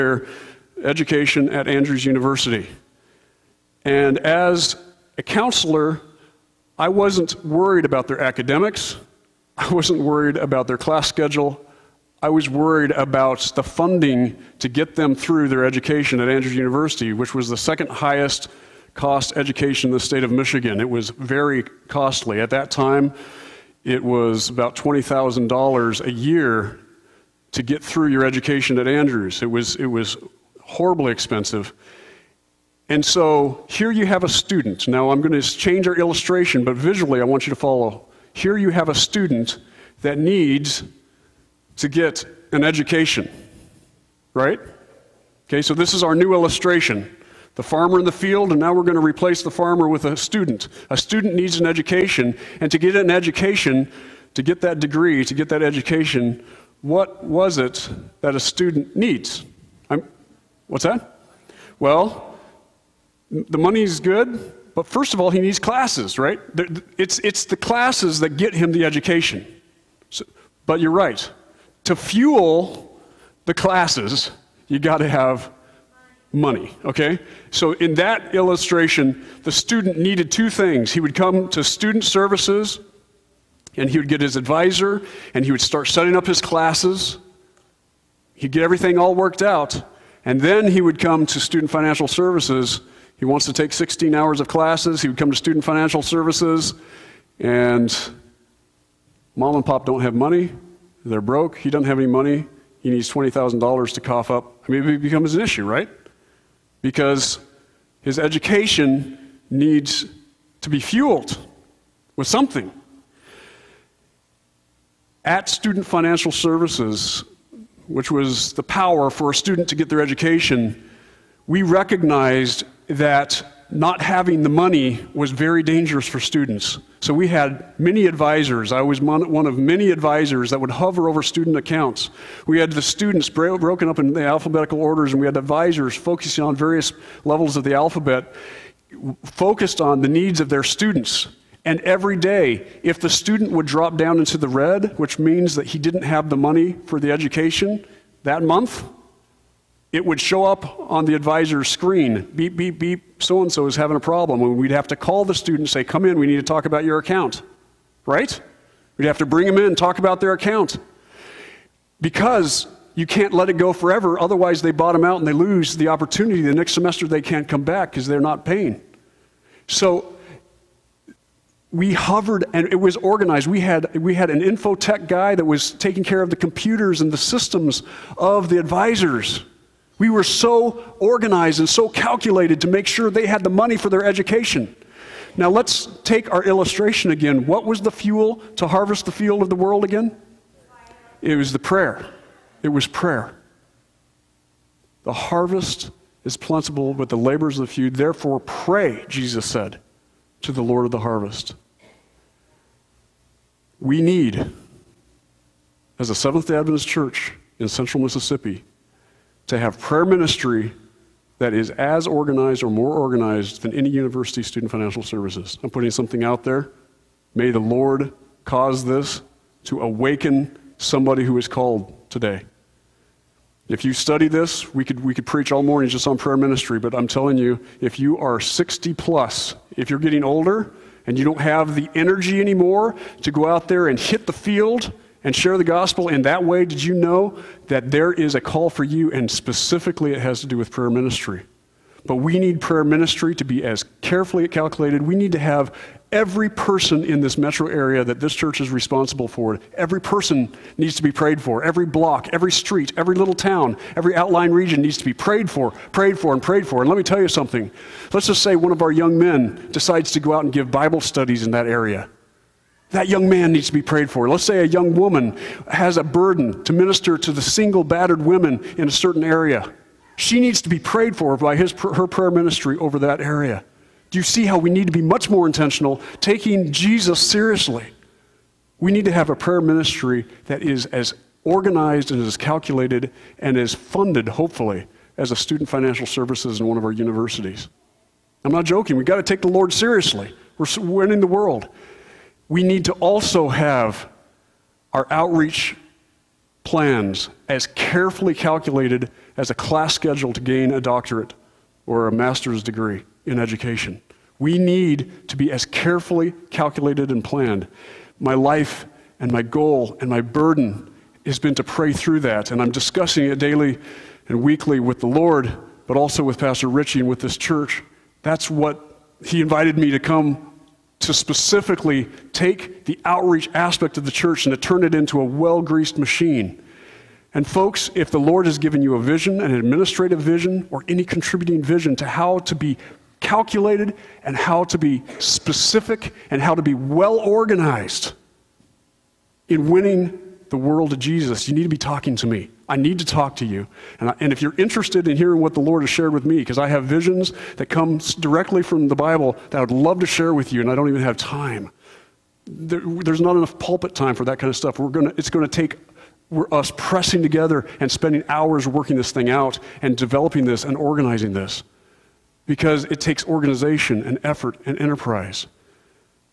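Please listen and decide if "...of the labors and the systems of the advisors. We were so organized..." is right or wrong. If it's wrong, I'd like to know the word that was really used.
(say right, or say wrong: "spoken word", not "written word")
wrong: "computers", not "labors".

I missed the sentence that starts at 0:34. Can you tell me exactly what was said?
Now I'm going to change our illustration, but visually I want you to follow.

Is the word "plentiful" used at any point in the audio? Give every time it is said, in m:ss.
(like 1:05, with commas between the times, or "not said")
3:16.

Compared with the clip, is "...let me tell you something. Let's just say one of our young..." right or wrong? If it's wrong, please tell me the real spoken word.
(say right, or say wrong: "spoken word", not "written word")
right.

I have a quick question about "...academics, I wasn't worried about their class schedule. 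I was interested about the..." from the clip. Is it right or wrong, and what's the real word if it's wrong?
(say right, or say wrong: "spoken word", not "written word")
wrong: "worried", not "interested".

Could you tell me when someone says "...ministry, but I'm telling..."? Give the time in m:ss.
3:46.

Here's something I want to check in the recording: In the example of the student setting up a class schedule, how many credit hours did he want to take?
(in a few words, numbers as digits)
16.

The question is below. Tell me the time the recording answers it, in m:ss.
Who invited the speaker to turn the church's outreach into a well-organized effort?
5:16.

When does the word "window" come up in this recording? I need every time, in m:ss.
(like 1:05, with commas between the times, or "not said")
not said.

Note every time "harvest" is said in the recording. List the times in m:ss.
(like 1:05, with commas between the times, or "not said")
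3:08, 3:15, 3:20.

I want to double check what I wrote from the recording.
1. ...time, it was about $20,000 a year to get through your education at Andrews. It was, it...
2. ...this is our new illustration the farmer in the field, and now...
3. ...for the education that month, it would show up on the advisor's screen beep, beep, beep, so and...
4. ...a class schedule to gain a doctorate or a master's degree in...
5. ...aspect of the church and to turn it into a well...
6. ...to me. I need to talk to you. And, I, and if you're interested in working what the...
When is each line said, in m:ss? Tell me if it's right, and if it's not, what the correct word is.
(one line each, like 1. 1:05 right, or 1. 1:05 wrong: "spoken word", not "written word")
1. 0:22 right
2. 0:45 right
3. 2:26 right
4. 4:59 right
5. 5:23 right
6. 5:42 wrong: "hearing", not "working".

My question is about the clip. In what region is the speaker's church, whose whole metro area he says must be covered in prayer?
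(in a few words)
Central Mississippi.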